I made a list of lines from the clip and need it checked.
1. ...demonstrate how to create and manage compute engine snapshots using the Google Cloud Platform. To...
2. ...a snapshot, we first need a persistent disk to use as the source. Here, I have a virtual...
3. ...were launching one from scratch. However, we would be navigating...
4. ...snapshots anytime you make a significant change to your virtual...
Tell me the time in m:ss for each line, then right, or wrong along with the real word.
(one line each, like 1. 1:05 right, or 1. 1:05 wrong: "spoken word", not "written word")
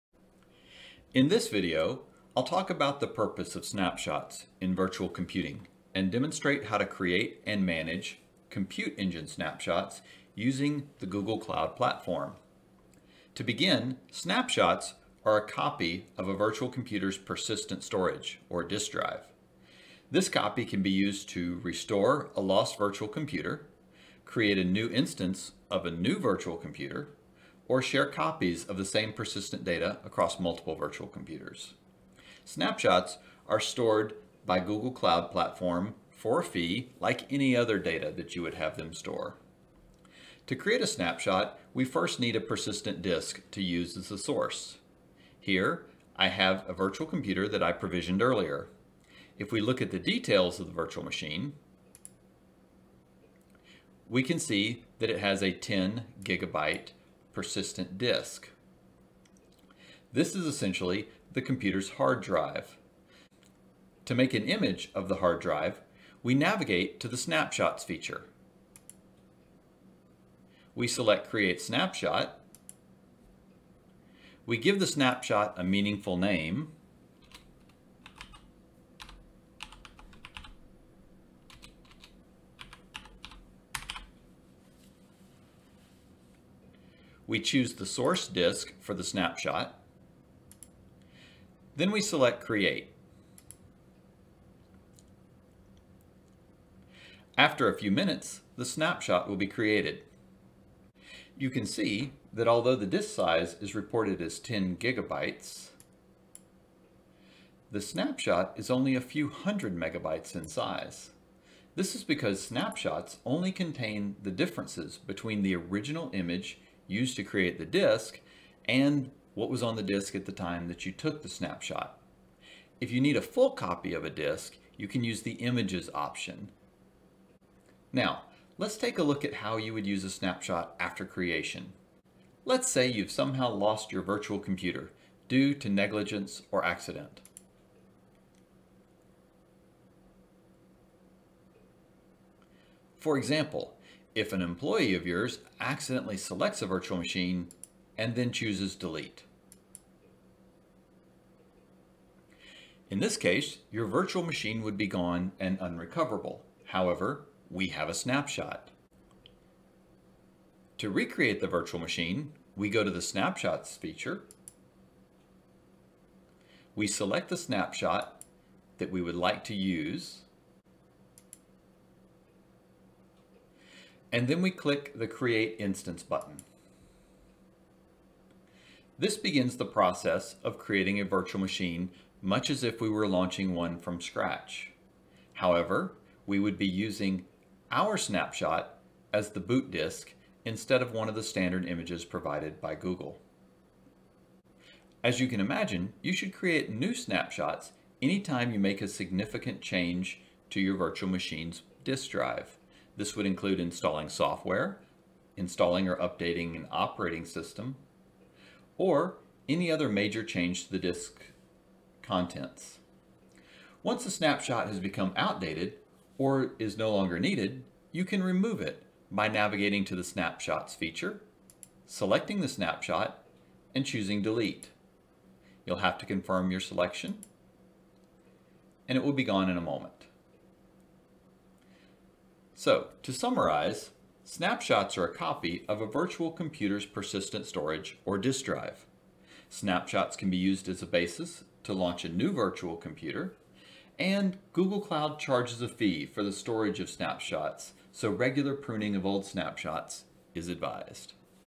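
1. 0:06 right
2. 0:40 right
3. 3:02 wrong: "using", not "navigating"
4. 3:16 right.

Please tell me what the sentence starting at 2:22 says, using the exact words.
For example, if an employee of yours accidentally selects a virtual machine and then chooses delete.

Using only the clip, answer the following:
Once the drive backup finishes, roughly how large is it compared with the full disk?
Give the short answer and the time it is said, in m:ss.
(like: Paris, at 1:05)
A few hundred megabytes, at 1:48.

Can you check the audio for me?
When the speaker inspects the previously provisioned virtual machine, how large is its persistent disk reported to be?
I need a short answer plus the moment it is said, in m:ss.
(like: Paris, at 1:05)
10 gigabytes, at 0:55.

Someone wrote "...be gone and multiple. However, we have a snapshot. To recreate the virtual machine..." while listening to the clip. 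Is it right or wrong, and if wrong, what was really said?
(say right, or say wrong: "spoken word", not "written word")
wrong: "unrecoverable", not "multiple".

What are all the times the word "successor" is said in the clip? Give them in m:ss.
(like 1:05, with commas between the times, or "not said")
not said.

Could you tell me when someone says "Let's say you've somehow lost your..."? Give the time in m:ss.
2:12.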